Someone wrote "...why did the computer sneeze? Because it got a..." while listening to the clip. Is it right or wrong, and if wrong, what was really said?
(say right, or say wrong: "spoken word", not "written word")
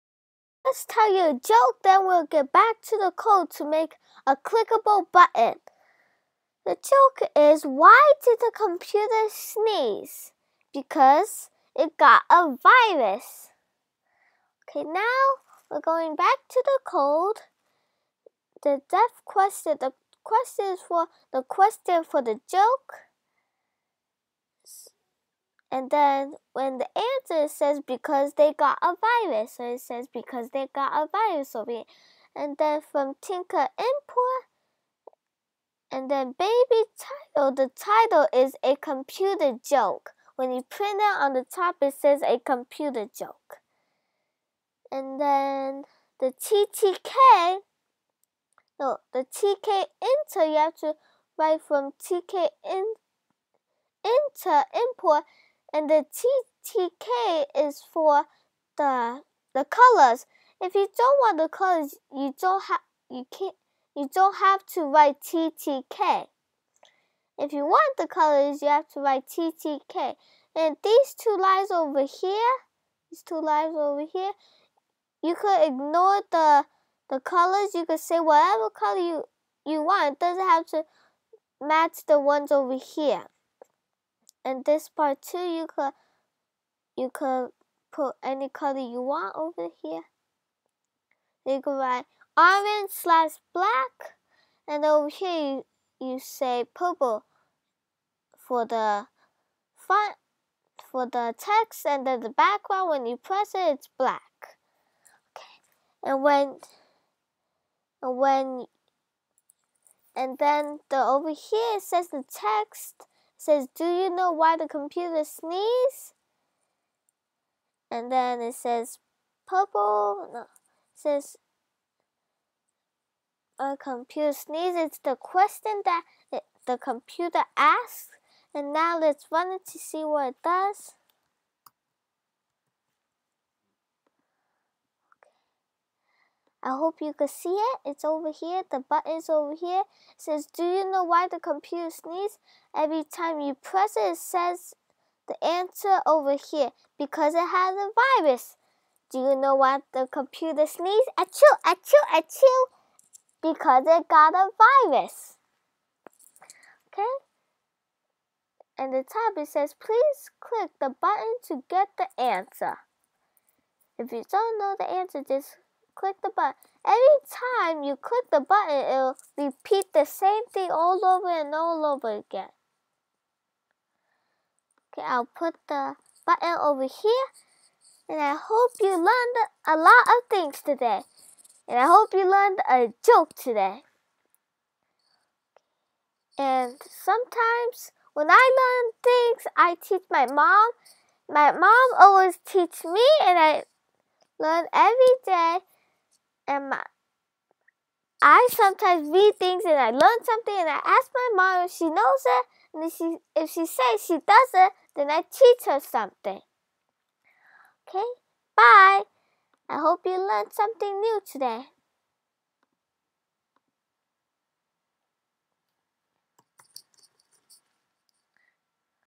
right.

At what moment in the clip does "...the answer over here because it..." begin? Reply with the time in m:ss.
2:25.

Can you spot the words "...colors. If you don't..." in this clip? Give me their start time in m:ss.
0:59.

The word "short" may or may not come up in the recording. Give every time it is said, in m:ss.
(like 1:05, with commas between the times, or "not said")
not said.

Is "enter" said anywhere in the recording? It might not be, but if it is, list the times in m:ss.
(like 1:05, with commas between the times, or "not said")
0:50, 0:54.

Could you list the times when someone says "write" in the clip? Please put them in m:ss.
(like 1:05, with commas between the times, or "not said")
0:51, 1:04, 1:08, 1:31.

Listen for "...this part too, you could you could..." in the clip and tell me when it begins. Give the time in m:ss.
1:24.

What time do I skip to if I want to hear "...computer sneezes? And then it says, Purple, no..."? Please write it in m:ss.
1:54.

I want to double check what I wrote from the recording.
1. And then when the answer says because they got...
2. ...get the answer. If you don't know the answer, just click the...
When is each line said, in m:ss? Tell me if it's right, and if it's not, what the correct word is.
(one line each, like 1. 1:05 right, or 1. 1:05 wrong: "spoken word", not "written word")
1. 0:25 right
2. 2:41 right.